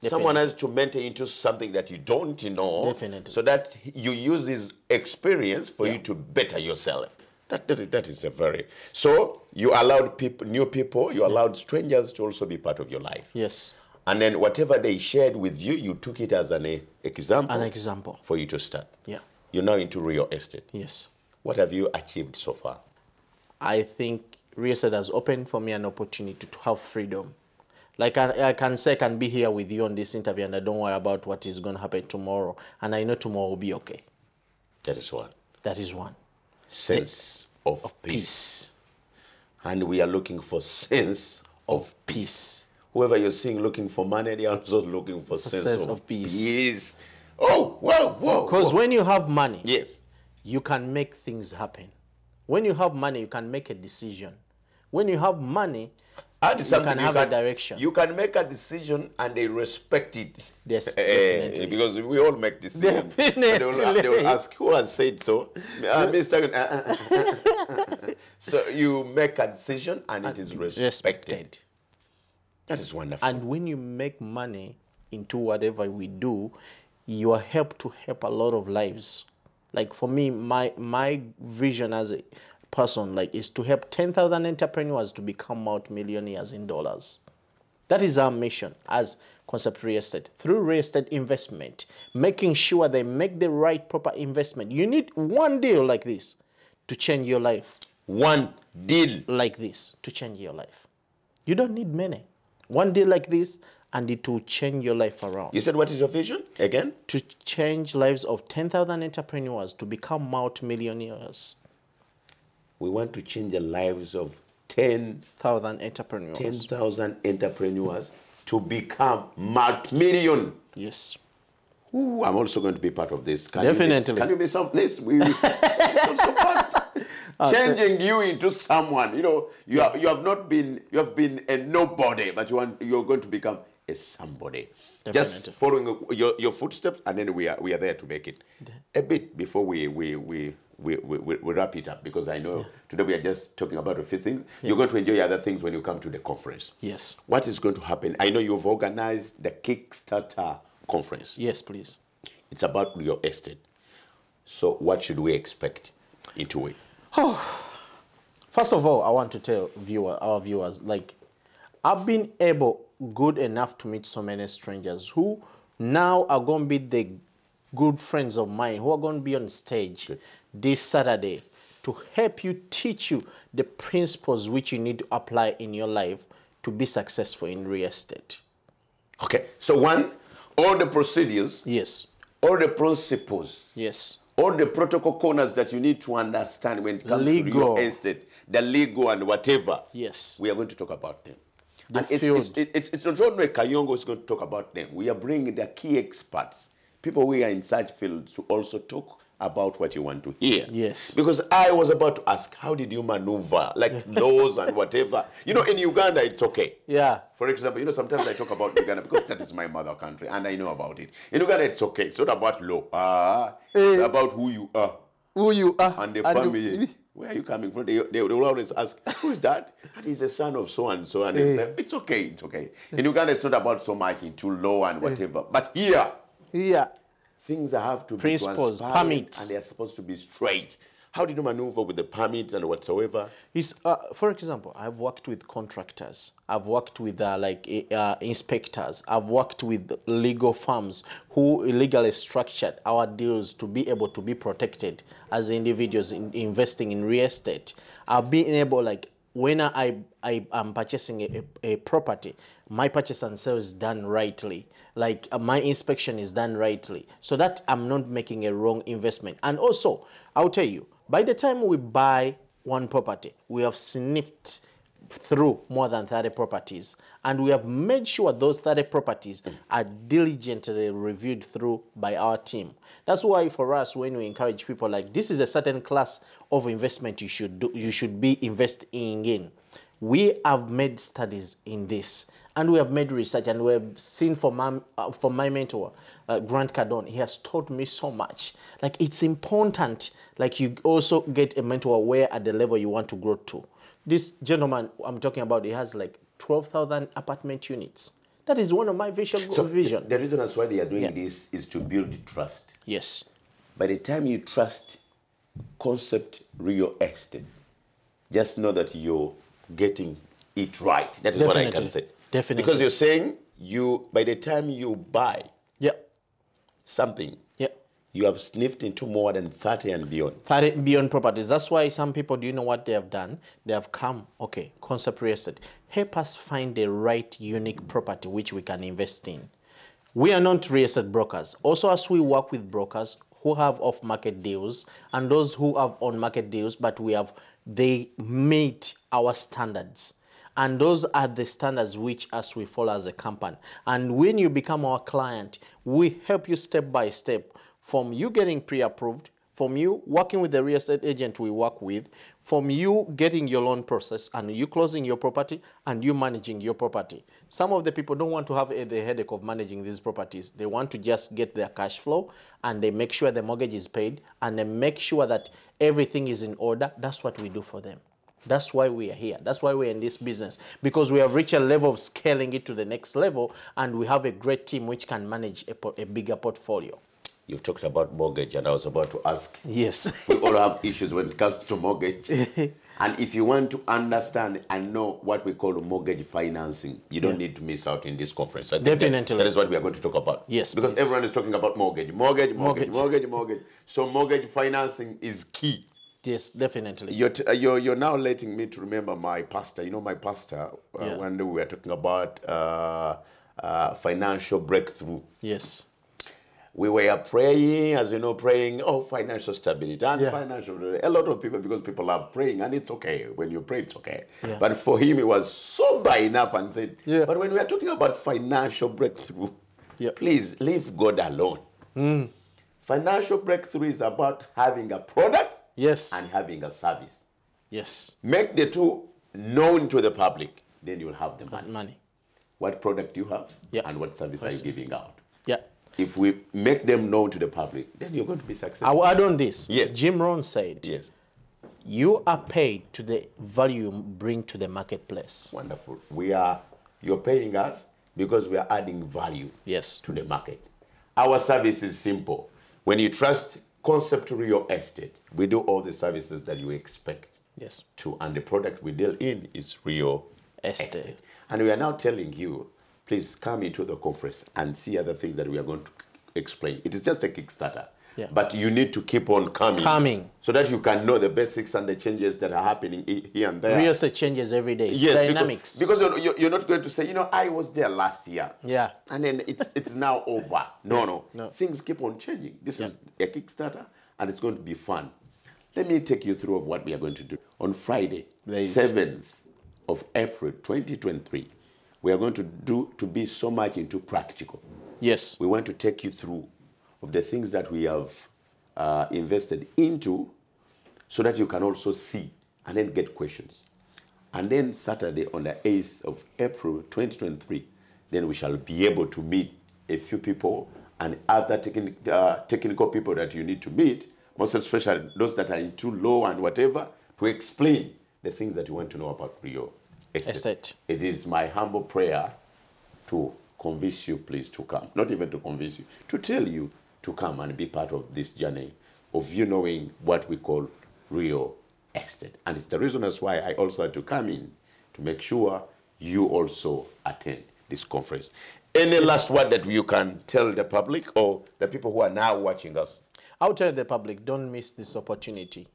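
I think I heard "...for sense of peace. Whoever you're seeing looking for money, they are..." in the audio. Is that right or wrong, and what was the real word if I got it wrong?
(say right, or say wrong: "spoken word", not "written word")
right.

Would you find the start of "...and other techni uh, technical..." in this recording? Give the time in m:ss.
8:30.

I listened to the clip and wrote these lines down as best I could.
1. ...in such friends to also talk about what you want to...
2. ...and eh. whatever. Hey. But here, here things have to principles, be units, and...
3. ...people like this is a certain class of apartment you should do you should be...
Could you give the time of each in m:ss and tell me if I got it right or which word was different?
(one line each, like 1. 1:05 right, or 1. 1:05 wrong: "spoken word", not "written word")
1. 3:17 wrong: "fields", not "friends"
2. 3:44 wrong: "permits", not "units"
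3. 4:34 wrong: "investment", not "apartment".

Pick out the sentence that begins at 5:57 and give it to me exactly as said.
Some of the people don't want to have the headache of managing these properties.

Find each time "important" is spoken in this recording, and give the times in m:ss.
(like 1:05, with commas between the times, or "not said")
4:49.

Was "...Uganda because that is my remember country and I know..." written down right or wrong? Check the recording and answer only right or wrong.
wrong.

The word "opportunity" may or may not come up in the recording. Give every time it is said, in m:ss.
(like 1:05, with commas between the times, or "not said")
0:25, 9:04.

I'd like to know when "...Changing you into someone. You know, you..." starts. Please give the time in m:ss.
2:07.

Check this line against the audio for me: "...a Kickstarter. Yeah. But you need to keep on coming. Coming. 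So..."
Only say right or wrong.
right.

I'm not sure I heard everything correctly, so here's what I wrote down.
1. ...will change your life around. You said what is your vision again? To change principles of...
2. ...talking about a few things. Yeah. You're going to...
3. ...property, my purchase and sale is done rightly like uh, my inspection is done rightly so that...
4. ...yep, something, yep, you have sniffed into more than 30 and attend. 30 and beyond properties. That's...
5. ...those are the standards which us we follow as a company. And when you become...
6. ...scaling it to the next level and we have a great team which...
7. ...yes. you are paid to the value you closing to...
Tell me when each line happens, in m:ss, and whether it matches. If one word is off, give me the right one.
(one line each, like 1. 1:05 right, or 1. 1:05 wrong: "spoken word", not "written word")
1. 1:44 wrong: "lives", not "principles"
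2. 2:23 right
3. 4:11 right
4. 5:15 wrong: "beyond", not "attend"
5. 5:40 right
6. 6:11 right
7. 7:20 wrong: "bring", not "closing".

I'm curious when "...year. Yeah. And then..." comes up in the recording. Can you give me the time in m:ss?
7:58.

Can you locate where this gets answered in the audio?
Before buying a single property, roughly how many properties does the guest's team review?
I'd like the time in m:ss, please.
4:25.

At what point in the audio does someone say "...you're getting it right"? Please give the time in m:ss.
5:08.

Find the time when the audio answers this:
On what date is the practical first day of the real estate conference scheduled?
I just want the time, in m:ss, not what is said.
8:08.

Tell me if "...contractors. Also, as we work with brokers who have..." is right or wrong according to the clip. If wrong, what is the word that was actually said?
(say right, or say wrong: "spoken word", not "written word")
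wrong: "brokers", not "contractors".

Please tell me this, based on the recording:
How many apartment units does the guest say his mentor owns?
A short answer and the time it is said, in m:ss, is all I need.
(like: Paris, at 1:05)
12,000, at 4:56.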